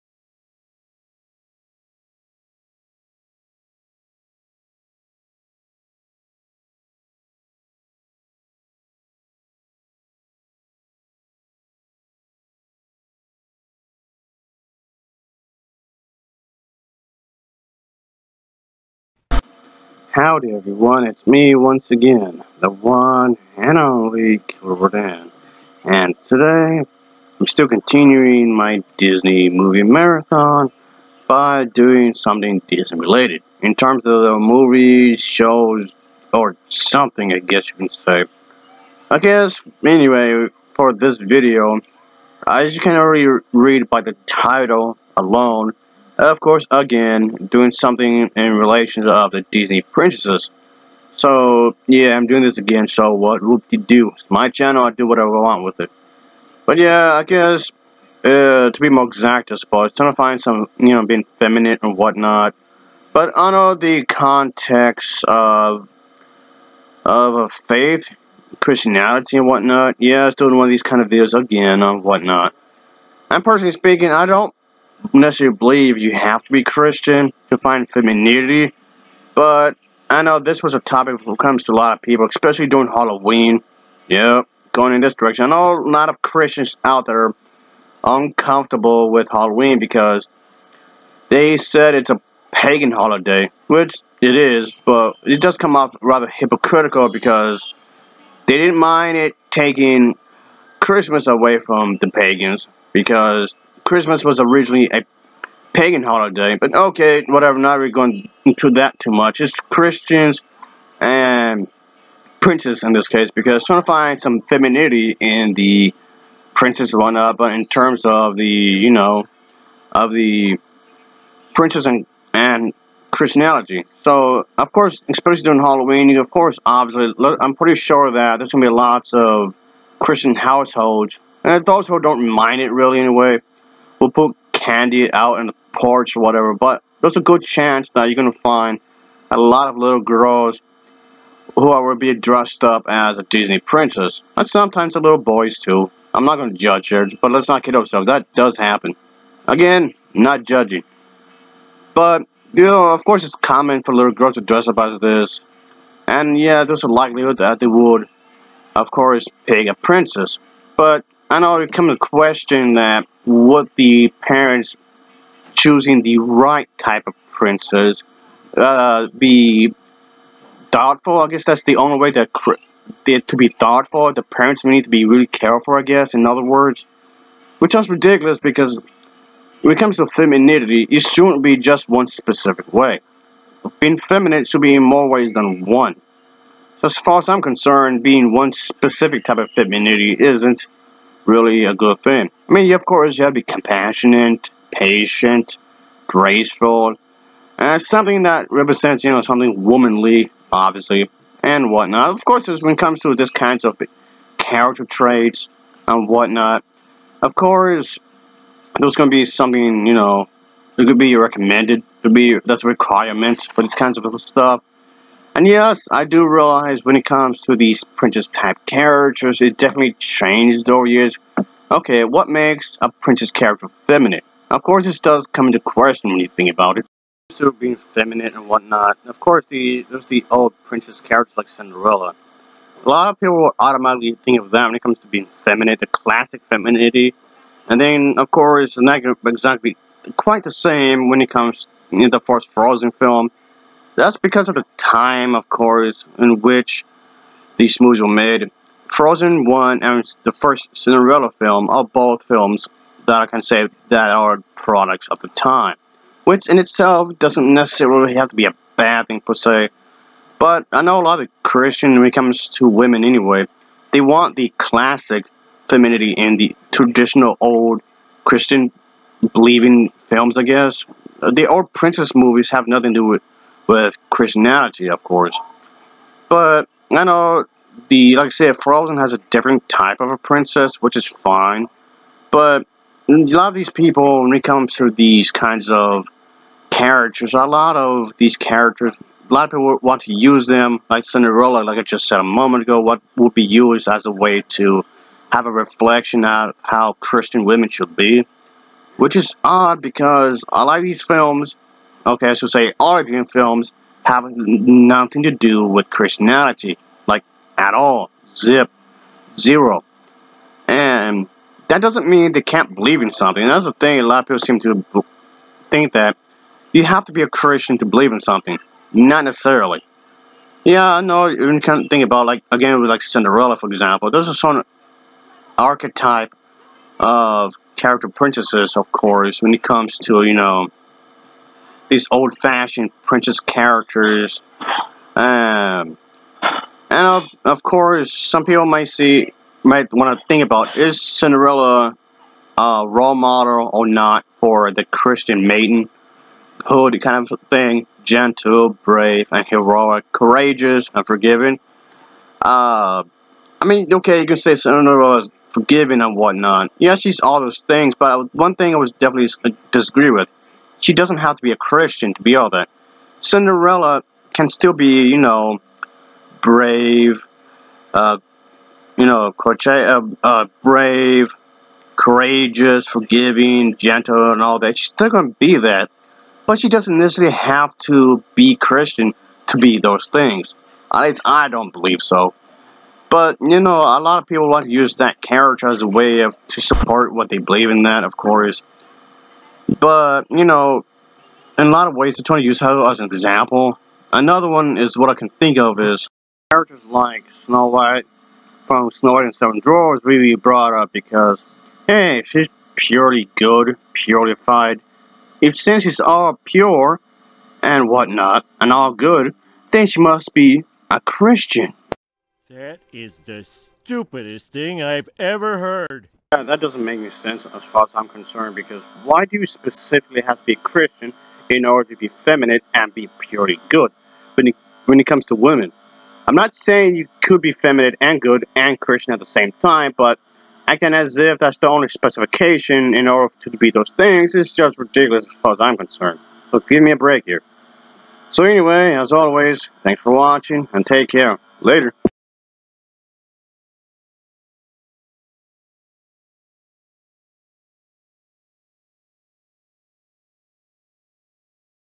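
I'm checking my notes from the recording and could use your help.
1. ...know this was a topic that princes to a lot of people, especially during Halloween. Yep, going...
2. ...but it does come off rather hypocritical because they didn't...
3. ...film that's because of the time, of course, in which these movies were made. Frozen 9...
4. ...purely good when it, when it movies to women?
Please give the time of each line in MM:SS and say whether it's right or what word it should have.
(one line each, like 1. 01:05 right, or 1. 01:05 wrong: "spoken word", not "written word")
1. 01:20 wrong: "comes", not "princes"
2. 01:34 right
3. 04:02 wrong: "1", not "9"
4. 07:03 wrong: "comes", not "movies".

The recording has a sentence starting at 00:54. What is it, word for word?
It's my channel, I do whatever I want with it.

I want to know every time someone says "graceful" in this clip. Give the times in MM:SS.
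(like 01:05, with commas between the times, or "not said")
03:16.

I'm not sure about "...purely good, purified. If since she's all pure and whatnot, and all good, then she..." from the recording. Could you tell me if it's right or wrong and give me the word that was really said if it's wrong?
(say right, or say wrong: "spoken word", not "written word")
right.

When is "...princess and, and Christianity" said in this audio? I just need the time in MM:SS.
02:01.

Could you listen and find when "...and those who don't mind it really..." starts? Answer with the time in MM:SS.
02:11.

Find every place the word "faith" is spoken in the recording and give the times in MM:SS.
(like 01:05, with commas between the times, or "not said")
01:07.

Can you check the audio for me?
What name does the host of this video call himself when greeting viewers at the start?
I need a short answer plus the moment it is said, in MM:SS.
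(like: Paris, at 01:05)
Killer, at 00:24.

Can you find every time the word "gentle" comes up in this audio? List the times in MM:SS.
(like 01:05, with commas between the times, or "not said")
05:48, 06:13.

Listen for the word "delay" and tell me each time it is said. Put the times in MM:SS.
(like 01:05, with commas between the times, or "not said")
not said.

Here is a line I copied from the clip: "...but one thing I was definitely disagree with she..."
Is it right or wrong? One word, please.
right.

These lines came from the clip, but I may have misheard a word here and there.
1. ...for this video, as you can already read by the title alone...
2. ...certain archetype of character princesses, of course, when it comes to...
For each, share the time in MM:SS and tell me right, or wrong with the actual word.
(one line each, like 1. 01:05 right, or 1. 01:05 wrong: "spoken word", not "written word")
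1. 00:40 right
2. 05:24 right.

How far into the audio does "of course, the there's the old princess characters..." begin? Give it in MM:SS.
03:49.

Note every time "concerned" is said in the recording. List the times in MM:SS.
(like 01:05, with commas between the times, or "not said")
03:07, 06:58, 07:15.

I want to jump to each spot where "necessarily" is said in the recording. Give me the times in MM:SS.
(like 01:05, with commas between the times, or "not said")
01:15, 04:17, 05:19, 06:16.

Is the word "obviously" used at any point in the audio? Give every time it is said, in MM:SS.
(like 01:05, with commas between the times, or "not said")
02:06, 03:20.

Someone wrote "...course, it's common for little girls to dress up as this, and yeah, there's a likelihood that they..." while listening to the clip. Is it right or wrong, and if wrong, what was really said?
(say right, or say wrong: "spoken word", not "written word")
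right.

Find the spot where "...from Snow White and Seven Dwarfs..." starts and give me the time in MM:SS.
06:38.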